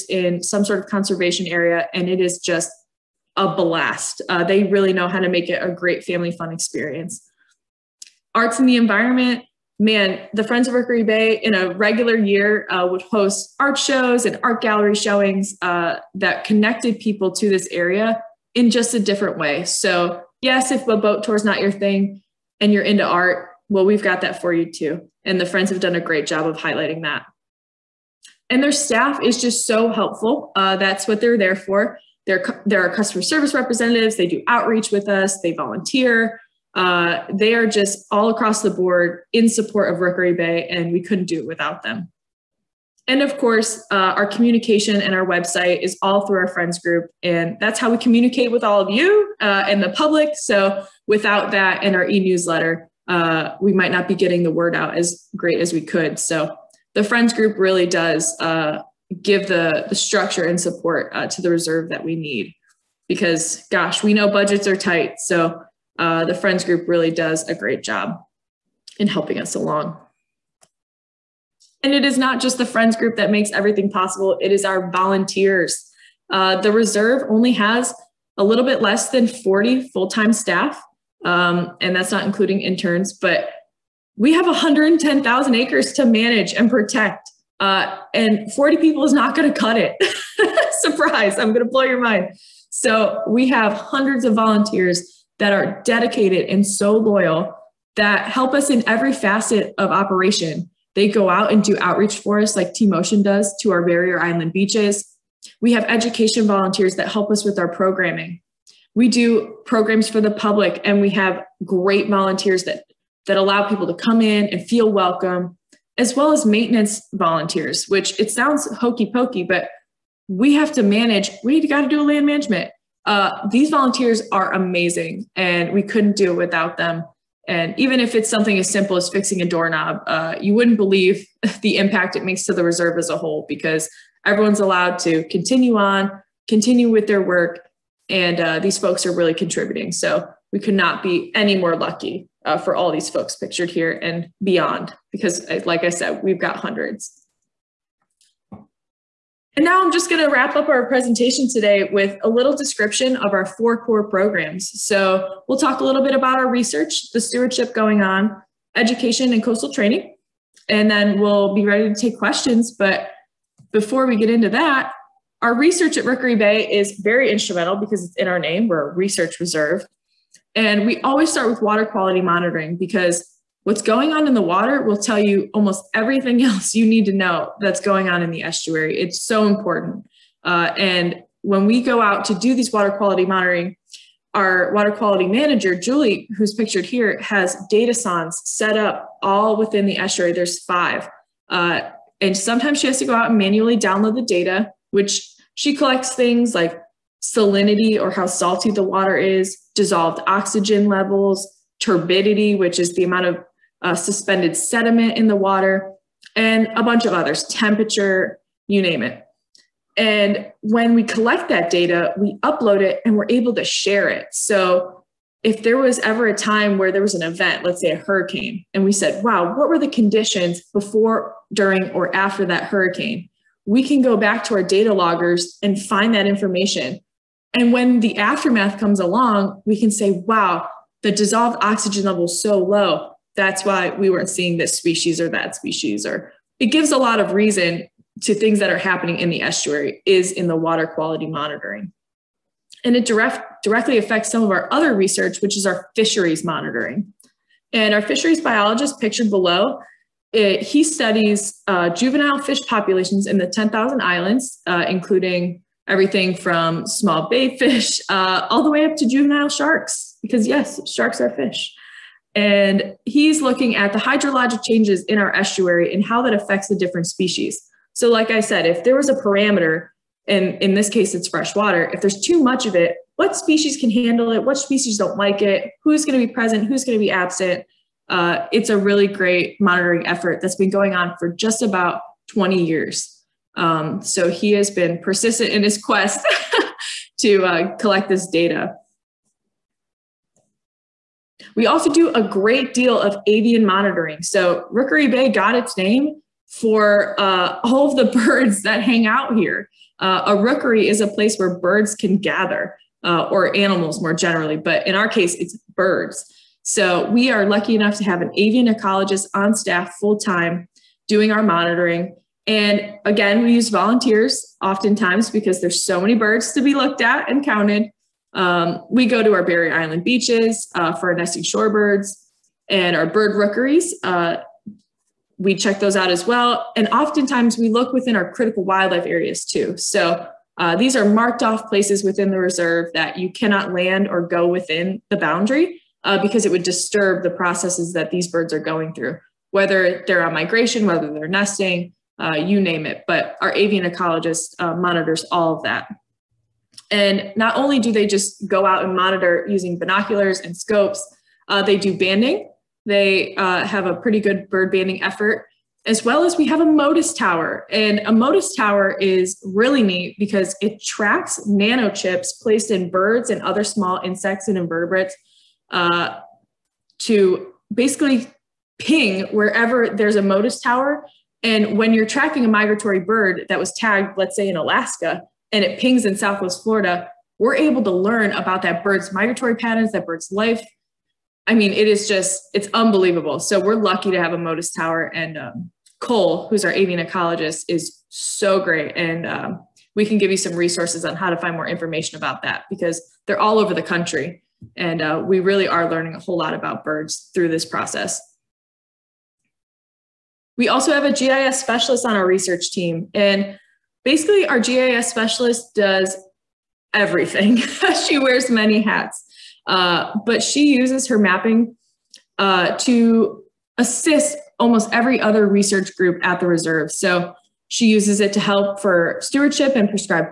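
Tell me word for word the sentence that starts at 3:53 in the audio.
That's why we weren't seeing this species or that species.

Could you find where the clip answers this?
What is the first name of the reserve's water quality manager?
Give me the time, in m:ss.
3:05.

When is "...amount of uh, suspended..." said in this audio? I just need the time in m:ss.
3:23.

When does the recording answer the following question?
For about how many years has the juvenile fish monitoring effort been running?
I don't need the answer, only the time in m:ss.
4:42.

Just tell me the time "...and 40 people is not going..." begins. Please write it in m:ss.
1:28.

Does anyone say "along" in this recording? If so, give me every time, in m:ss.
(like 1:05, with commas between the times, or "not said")
1:09, 3:48.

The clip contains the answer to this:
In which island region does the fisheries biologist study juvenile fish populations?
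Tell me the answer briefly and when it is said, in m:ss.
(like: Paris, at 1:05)
10,000 Islands, at 4:13.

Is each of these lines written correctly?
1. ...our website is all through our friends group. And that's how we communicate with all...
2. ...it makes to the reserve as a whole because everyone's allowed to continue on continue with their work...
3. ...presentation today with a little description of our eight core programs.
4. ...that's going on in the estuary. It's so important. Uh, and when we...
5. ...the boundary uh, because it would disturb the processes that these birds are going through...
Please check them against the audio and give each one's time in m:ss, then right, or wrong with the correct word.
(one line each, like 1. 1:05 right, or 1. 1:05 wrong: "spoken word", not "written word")
1. 0:45 right
2. 2:12 right
3. 2:30 wrong: "four", not "eight"
4. 2:57 right
5. 5:35 right.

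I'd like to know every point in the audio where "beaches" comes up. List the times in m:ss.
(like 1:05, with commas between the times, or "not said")
1:44, 5:20.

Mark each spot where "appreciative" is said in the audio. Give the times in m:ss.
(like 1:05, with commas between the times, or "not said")
not said.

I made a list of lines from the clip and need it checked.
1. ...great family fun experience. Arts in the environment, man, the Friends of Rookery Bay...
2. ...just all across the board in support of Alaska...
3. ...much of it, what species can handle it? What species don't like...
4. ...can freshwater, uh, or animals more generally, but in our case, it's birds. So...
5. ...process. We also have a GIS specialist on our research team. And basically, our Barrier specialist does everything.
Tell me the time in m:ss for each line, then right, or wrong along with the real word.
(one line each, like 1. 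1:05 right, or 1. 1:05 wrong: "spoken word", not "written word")
1. 0:05 right
2. 0:37 wrong: "Rookery", not "Alaska"
3. 4:32 right
4. 5:01 wrong: "gather", not "freshwater"
5. 6:37 wrong: "GIS", not "Barrier".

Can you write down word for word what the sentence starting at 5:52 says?
They uh, have a pretty good bird banding effort as well as we have a Motus tower.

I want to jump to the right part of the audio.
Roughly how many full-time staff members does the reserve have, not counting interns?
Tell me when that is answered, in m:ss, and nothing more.
1:19.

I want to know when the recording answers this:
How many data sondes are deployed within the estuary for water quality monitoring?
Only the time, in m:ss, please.
3:10.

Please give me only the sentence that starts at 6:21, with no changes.
I mean, it is just, it's unbelievable.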